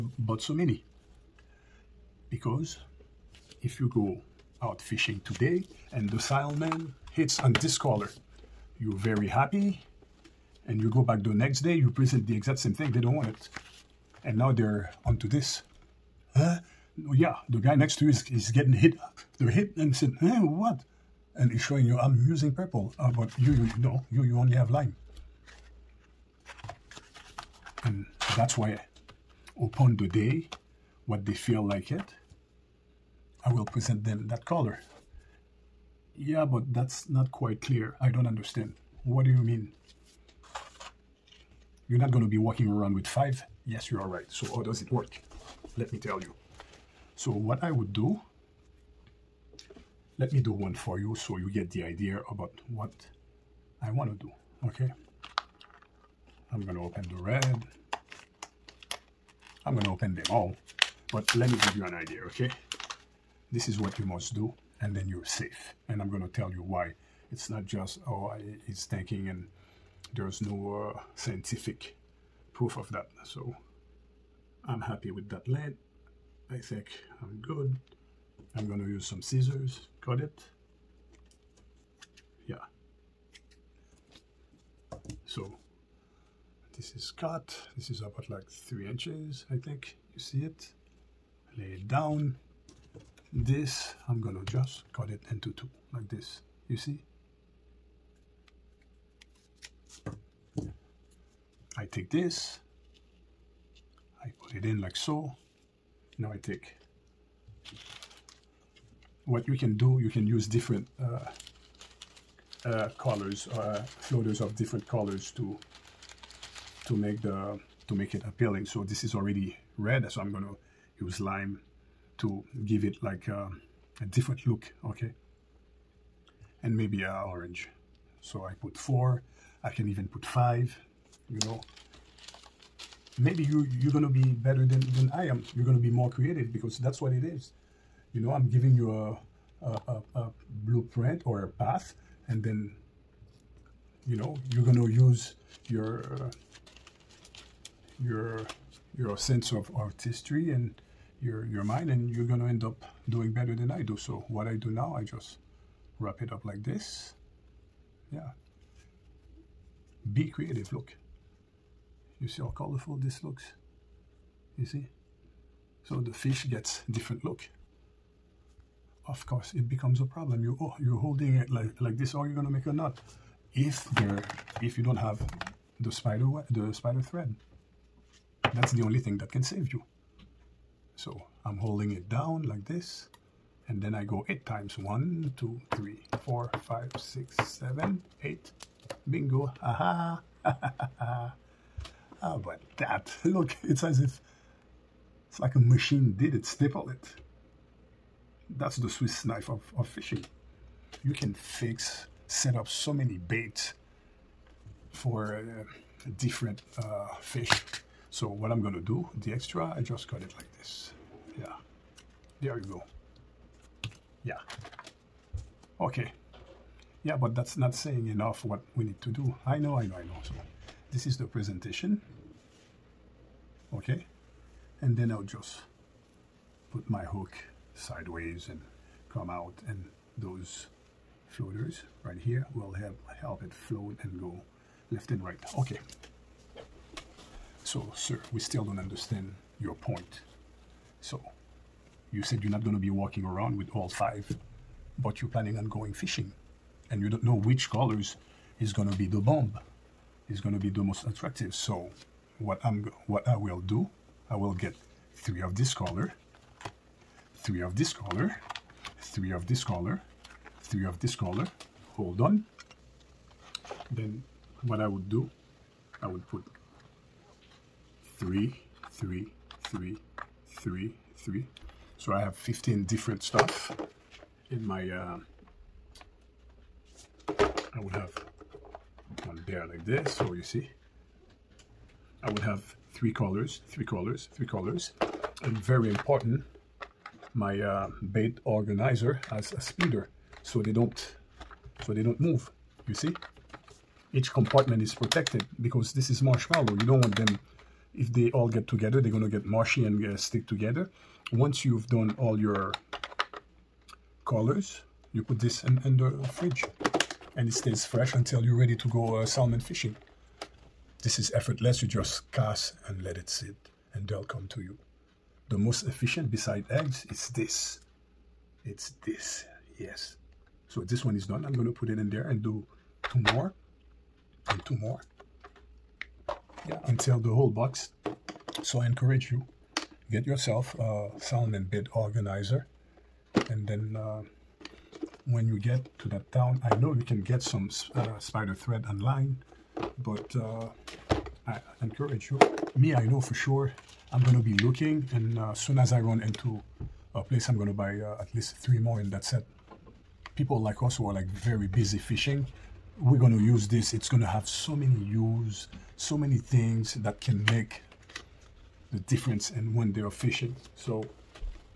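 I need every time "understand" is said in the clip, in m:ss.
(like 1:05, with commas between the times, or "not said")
0:38, 3:58.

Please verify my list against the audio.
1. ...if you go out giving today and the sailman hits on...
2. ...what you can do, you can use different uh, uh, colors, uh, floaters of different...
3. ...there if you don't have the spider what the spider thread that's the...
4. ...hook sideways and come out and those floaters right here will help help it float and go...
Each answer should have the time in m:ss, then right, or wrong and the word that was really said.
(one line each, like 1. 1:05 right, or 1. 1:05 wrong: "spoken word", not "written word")
1. 0:03 wrong: "fishing", not "giving"
2. 1:49 right
3. 2:53 right
4. 3:47 right.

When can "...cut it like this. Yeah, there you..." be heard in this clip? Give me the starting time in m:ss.
3:30.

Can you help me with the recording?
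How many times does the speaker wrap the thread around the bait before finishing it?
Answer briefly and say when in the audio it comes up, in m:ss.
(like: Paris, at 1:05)
8, at 3:04.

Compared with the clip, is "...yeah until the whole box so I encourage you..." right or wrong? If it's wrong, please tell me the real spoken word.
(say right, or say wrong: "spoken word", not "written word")
right.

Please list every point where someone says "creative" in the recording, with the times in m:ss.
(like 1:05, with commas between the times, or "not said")
2:16, 2:40.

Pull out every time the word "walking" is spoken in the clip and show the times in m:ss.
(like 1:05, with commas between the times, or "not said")
0:42, 4:02.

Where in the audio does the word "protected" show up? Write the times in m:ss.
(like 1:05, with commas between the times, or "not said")
4:54.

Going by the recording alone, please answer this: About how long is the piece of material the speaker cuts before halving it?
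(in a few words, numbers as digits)
3 inches.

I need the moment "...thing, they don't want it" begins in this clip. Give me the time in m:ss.
0:12.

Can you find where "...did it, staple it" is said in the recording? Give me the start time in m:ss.
3:16.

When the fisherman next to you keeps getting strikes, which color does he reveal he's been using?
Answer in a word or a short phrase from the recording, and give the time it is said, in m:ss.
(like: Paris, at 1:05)
purple, at 0:22.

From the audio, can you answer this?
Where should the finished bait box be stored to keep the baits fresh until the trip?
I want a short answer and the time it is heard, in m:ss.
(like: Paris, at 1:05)
in the fridge, at 5:06.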